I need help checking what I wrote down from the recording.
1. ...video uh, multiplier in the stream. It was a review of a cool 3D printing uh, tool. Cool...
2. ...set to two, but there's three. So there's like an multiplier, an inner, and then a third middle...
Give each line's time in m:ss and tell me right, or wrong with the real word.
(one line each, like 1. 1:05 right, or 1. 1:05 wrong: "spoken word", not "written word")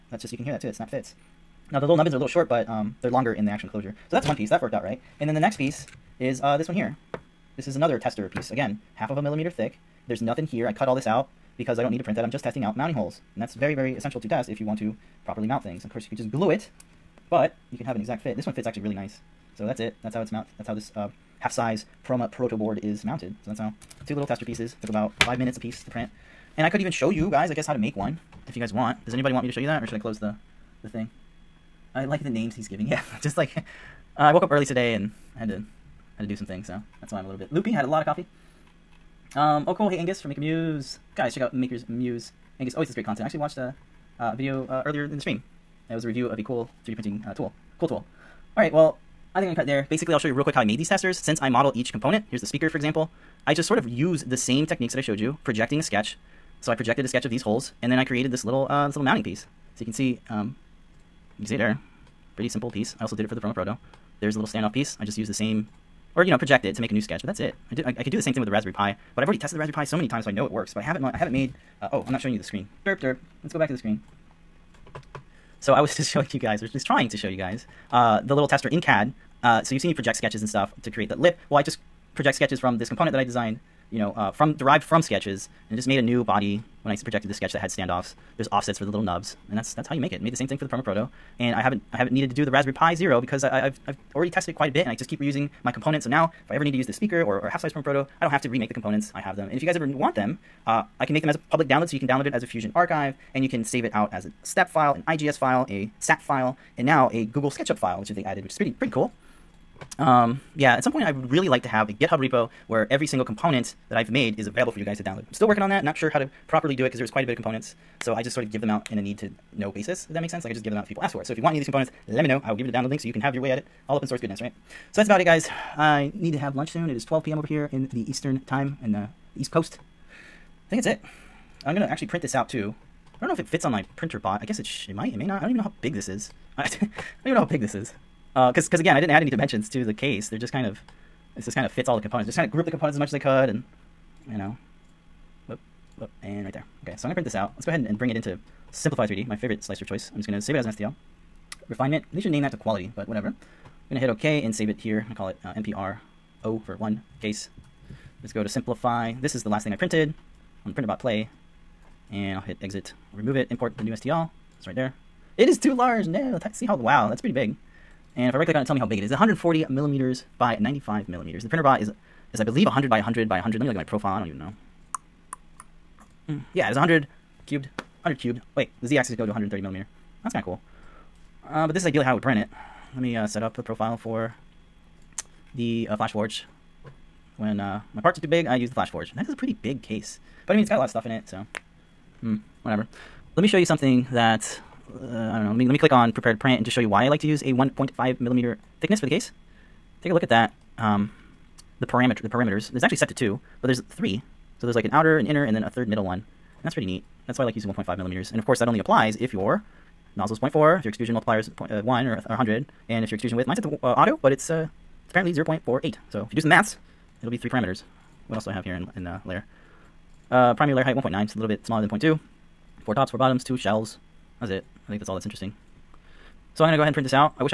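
1. 0:44 wrong: "earlier", not "multiplier"
2. 3:22 wrong: "outer", not "multiplier".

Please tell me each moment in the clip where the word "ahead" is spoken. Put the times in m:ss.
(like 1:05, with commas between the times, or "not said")
2:27, 3:46.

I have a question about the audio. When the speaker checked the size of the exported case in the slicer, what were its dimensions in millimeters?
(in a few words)
140 by 95 millimeters.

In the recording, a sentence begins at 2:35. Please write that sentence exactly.
I call it uh, MPR O for one case Let's go to simplify.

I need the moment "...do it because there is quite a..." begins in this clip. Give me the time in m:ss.
1:56.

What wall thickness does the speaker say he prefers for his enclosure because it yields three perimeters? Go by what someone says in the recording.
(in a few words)
1.5 millimeters.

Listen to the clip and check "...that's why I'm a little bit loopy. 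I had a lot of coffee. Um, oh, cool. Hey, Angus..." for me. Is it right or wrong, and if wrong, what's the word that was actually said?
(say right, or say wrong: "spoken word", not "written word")
right.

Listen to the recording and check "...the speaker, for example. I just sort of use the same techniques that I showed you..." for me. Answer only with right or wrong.
right.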